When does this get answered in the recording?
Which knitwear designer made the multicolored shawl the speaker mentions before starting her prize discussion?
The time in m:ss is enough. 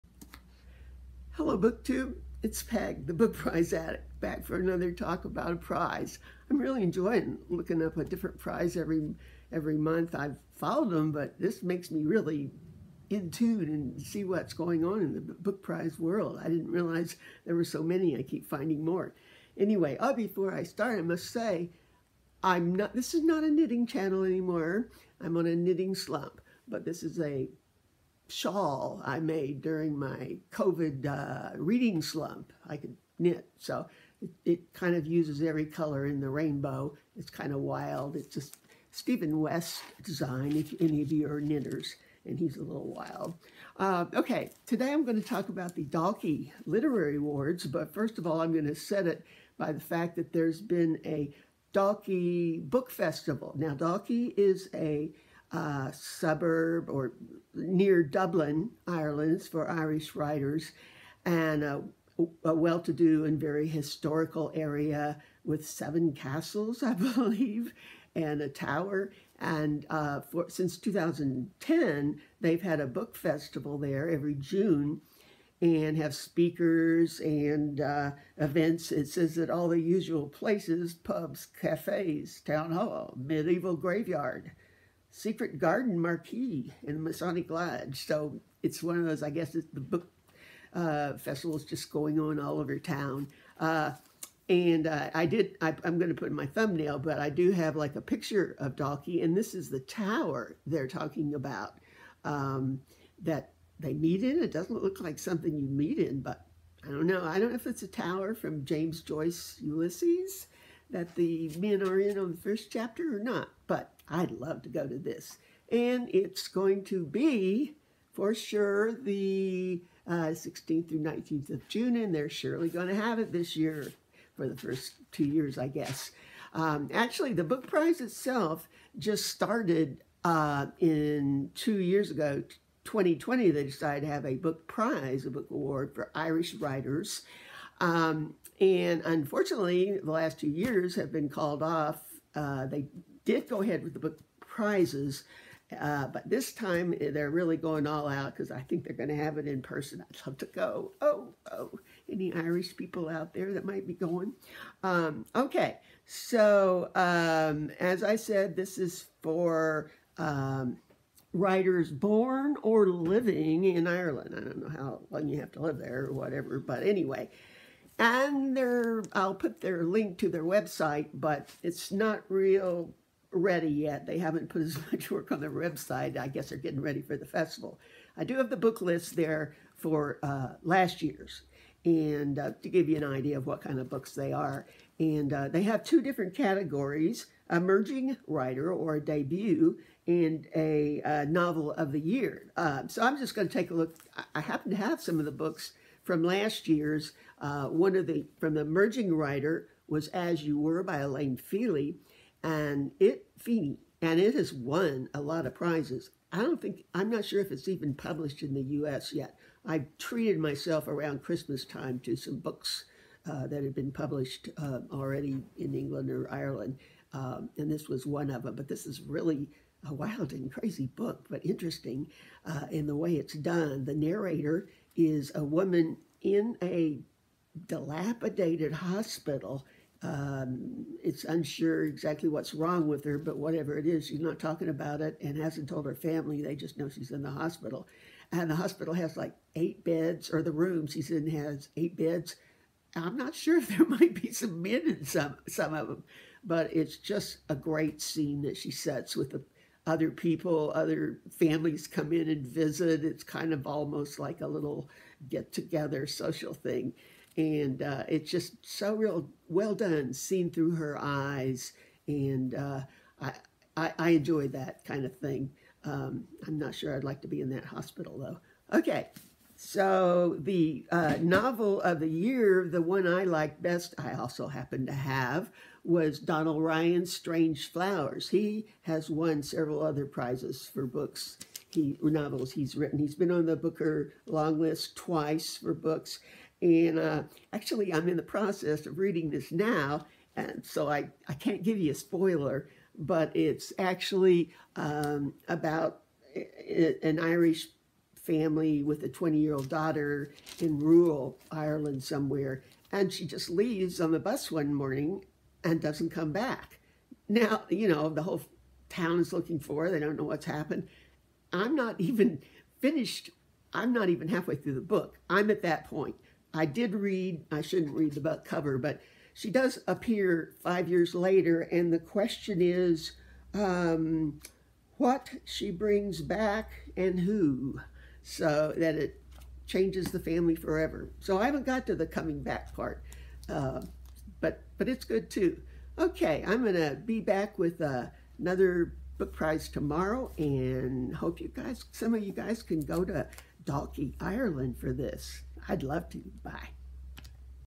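0:38.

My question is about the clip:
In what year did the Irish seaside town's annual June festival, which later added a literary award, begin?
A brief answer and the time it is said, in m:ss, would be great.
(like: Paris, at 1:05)
2010, at 1:10.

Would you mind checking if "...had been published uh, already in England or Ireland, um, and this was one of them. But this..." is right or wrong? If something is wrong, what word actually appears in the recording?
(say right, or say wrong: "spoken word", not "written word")
right.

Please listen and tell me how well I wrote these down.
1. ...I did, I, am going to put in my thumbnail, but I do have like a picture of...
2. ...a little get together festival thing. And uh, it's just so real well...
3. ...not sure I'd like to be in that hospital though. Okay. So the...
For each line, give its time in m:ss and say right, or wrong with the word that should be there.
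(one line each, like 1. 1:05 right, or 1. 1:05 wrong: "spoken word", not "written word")
1. 1:35 right
2. 4:14 wrong: "social", not "festival"
3. 4:26 right.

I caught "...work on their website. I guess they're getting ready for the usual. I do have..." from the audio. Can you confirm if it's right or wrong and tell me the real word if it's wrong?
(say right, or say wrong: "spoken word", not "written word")
wrong: "festival", not "usual".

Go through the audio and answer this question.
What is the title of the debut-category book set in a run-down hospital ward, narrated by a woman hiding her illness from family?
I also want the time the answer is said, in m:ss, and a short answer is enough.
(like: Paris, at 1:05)
As You Were, at 3:20.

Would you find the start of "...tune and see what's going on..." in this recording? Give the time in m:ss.
0:13.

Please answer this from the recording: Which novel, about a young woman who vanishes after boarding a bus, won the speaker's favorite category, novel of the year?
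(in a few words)
Strange Flowers.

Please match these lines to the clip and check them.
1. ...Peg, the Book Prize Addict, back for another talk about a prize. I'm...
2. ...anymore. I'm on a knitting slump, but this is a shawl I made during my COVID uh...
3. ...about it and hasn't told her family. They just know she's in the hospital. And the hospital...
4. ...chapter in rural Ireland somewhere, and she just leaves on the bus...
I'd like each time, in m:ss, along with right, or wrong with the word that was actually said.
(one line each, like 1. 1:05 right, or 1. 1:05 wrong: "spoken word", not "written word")
1. 0:02 right
2. 0:24 right
3. 3:54 right
4. 4:59 wrong: "daughter", not "chapter".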